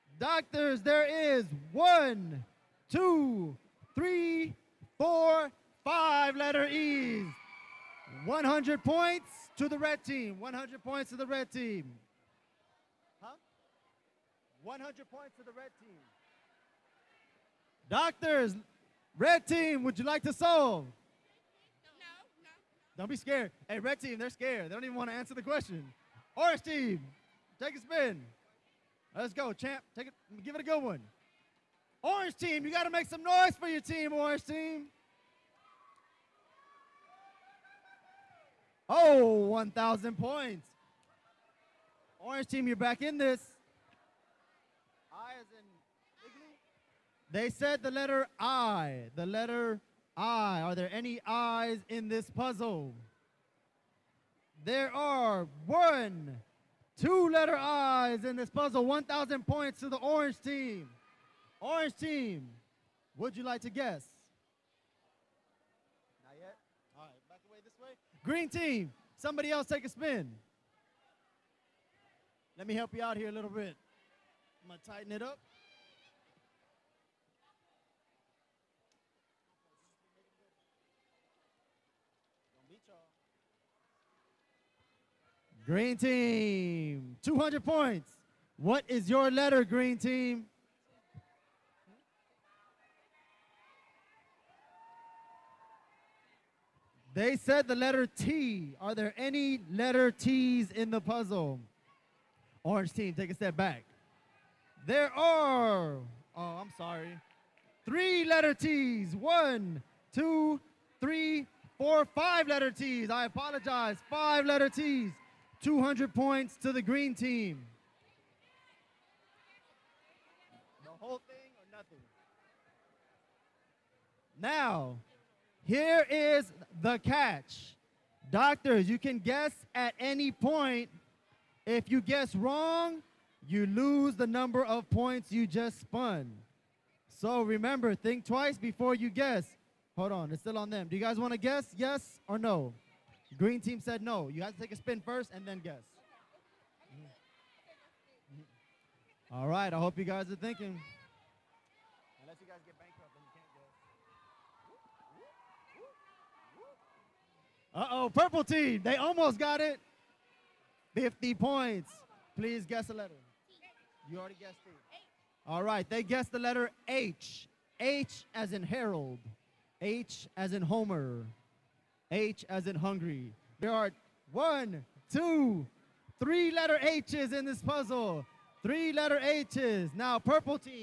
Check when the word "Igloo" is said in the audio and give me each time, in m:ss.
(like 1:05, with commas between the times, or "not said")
0:46.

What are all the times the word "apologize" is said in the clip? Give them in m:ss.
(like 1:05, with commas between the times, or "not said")
1:53.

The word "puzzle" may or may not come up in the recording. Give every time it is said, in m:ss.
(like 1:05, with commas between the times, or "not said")
0:52, 0:58, 1:41, 2:57.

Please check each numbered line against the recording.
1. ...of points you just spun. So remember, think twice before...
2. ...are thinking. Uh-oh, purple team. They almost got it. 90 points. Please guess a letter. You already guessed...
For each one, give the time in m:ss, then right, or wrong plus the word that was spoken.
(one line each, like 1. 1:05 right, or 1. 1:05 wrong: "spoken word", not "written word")
1. 2:14 right
2. 2:30 wrong: "50", not "90".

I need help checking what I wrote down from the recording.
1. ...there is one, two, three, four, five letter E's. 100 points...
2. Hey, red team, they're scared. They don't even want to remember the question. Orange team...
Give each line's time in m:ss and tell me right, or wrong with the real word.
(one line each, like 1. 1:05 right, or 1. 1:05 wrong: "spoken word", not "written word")
1. 0:00 right
2. 0:23 wrong: "answer", not "remember".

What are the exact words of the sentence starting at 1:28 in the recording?
What is your letter, green team?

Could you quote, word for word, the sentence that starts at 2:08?
Doctors, you can guess at any point.